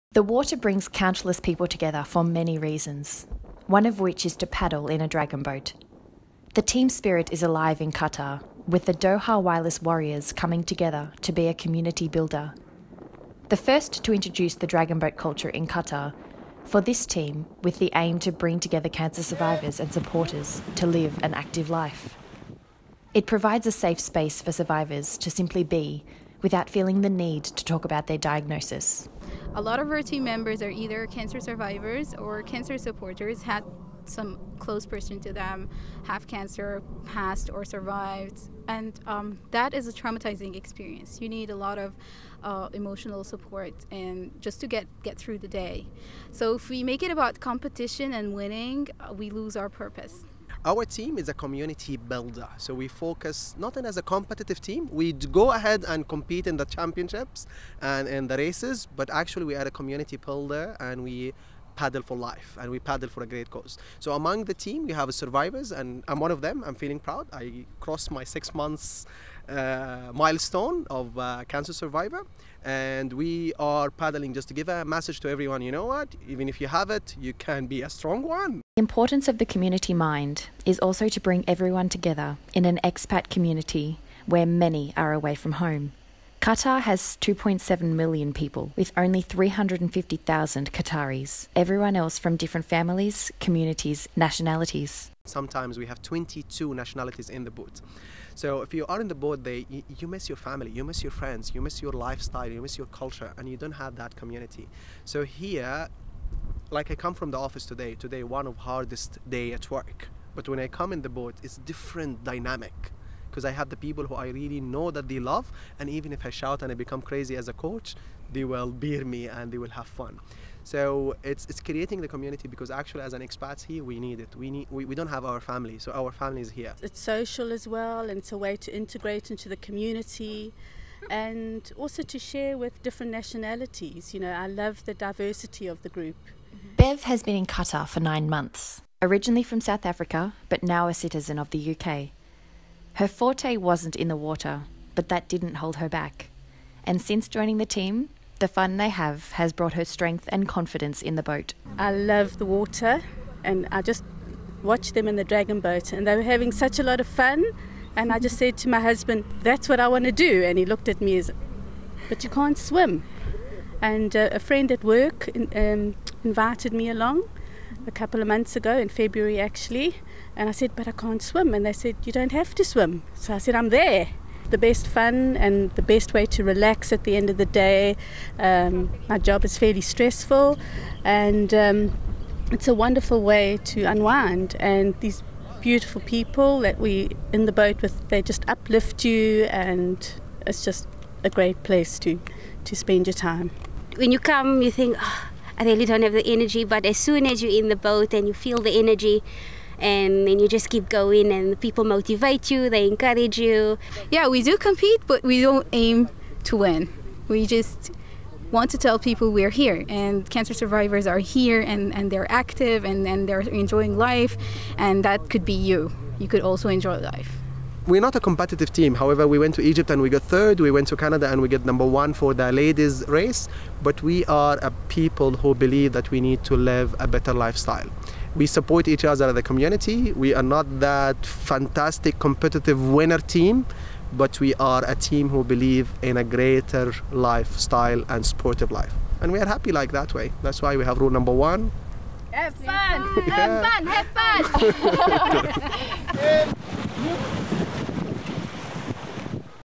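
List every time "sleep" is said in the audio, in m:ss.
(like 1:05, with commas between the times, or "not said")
not said.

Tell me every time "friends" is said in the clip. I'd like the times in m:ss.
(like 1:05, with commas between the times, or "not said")
1:41, 2:44.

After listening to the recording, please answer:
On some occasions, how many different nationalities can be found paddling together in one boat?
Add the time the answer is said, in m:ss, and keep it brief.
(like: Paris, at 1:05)
22, at 1:36.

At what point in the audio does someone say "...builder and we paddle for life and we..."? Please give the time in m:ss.
1:00.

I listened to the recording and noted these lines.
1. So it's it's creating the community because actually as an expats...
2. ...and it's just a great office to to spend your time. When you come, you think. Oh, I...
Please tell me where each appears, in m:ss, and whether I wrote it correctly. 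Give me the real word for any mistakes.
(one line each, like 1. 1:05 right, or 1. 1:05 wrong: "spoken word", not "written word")
1. 2:00 right
2. 3:09 wrong: "place", not "office".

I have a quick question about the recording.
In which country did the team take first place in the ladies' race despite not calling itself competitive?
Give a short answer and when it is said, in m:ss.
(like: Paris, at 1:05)
Canada, at 3:40.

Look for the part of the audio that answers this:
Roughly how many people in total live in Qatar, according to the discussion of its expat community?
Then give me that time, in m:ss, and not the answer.
1:27.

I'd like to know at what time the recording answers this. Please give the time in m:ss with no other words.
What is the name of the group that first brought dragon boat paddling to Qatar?
0:08.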